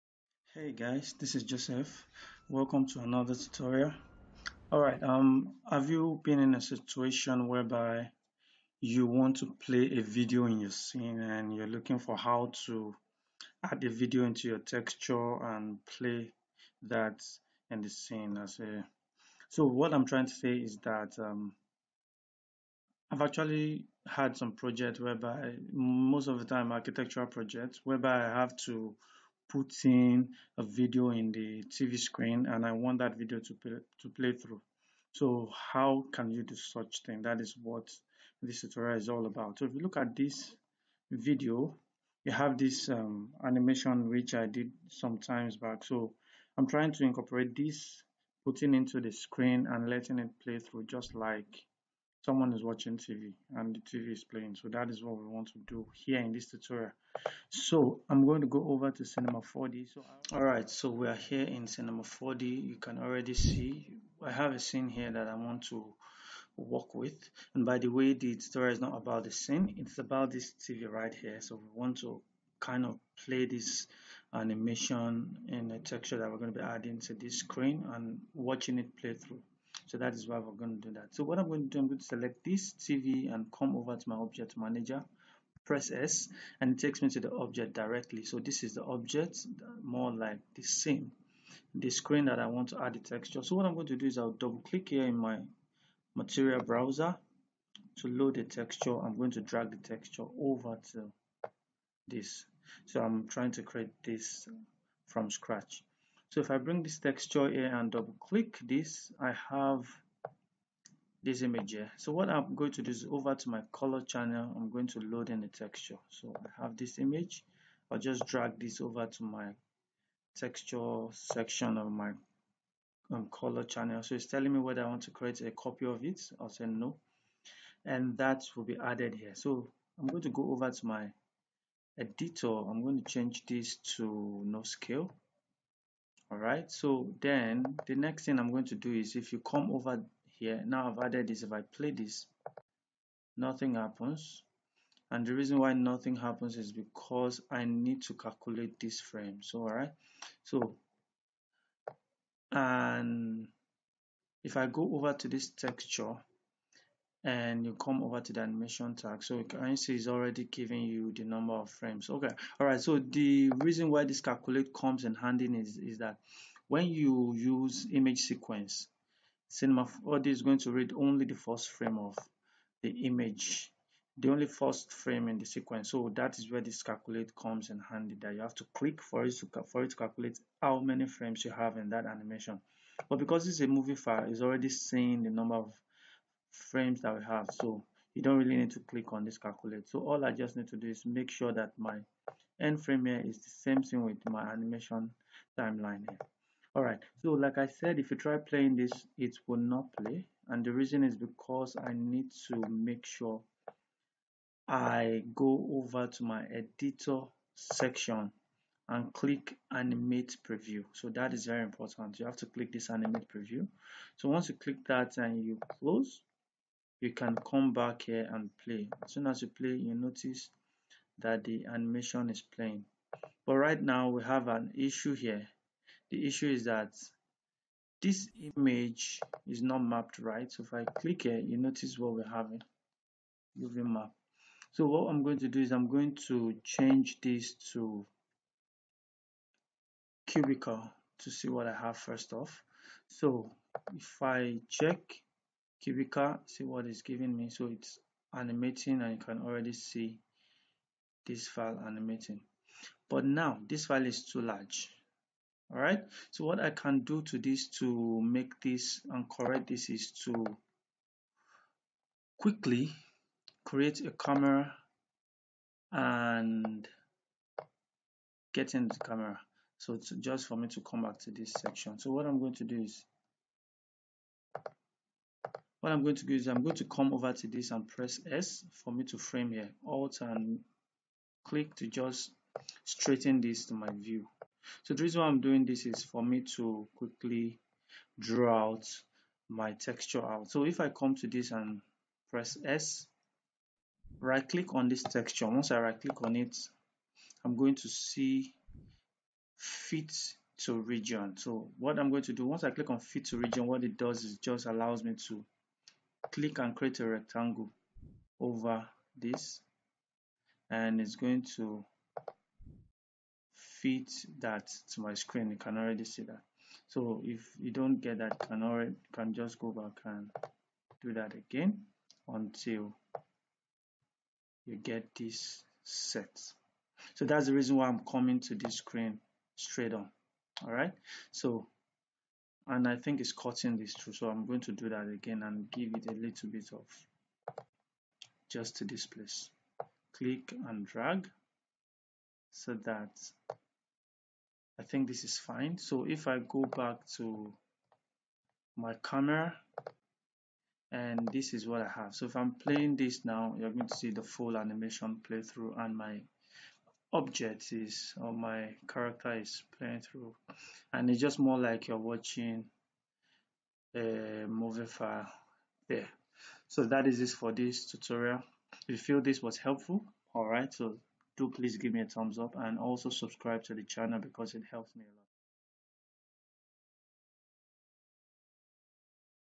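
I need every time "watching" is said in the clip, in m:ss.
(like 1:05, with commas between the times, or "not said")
0:52, 1:18, 6:01.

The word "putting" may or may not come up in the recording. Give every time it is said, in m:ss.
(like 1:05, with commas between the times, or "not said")
0:29, 0:48.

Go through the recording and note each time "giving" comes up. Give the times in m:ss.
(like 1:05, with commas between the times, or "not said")
2:40, 4:07.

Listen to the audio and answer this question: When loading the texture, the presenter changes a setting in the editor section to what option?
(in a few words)
no scale.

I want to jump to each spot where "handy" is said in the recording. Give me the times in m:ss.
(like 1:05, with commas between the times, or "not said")
2:45, 2:57.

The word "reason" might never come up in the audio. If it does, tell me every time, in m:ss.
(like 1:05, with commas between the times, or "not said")
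2:25, 2:43, 3:20, 4:45, 5:27.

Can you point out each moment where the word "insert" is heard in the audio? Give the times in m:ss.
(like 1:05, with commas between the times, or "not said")
not said.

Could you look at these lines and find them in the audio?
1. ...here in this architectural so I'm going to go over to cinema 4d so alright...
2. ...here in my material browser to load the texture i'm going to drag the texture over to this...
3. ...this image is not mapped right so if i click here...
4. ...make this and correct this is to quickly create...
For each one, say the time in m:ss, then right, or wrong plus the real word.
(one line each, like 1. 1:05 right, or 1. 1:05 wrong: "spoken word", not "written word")
1. 0:56 wrong: "tutorial", not "architectural"
2. 1:34 right
3. 3:48 right
4. 4:18 right.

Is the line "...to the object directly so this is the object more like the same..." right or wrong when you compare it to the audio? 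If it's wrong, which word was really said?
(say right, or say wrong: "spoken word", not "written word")
right.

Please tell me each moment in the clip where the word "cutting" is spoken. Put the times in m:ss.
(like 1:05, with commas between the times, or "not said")
5:33.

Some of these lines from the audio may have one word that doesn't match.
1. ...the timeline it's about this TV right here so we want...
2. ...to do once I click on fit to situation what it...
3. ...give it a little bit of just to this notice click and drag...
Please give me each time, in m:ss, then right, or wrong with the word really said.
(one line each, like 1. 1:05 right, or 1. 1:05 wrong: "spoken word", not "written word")
1. 1:09 wrong: "scene", not "timeline"
2. 5:02 wrong: "region", not "situation"
3. 5:35 wrong: "place", not "notice".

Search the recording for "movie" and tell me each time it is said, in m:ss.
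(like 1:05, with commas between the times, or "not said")
3:03, 6:04.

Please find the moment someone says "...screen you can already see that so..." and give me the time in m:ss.
5:15.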